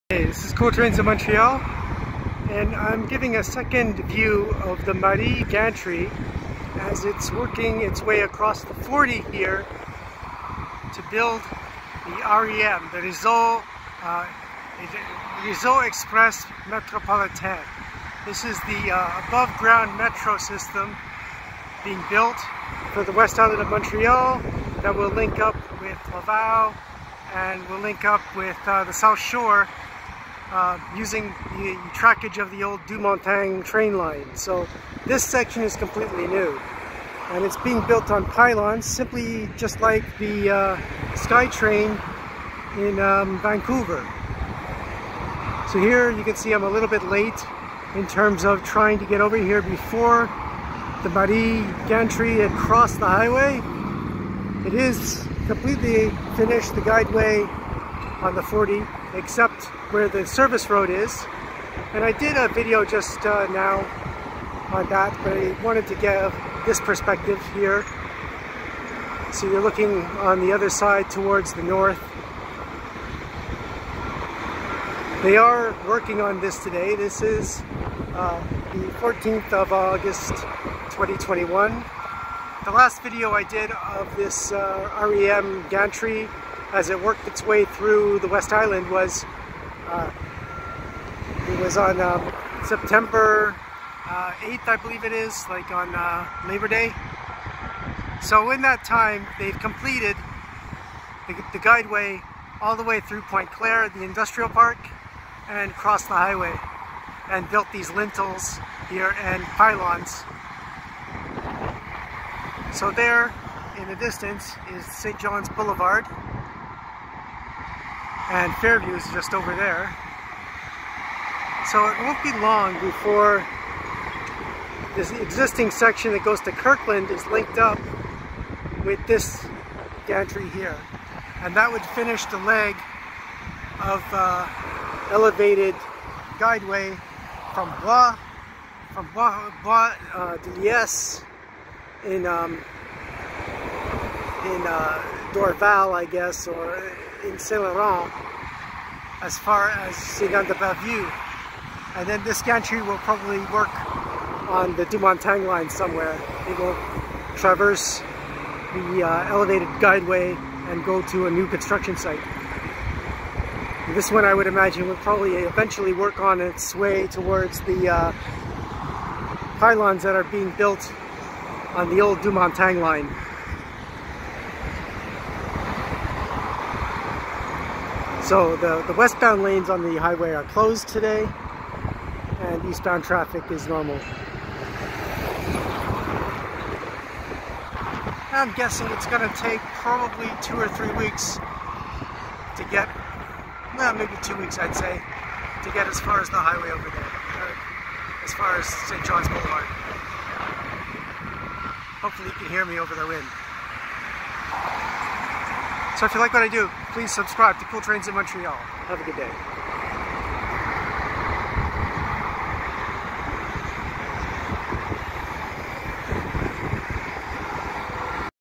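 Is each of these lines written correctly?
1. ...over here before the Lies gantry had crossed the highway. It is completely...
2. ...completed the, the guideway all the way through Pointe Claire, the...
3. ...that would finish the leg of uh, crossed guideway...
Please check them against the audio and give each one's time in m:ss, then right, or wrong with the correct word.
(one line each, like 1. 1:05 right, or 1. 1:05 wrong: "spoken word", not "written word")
1. 0:49 wrong: "Marie", not "Lies"
2. 1:39 right
3. 2:11 wrong: "elevated", not "crossed".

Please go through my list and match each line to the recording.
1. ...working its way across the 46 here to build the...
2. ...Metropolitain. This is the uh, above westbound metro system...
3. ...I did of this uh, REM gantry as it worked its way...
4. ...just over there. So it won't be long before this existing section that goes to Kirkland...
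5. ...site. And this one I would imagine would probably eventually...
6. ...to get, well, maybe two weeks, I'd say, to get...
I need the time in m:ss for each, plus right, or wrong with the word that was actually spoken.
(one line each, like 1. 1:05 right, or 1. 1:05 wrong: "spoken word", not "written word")
1. 0:07 wrong: "40", not "46"
2. 0:16 wrong: "ground", not "westbound"
3. 1:23 right
4. 1:59 right
5. 2:41 right
6. 3:12 right.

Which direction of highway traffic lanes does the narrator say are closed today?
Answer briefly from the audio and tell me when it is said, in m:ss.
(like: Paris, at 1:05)
westbound, at 2:58.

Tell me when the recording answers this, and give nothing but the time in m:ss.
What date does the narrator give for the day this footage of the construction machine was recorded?
1:18.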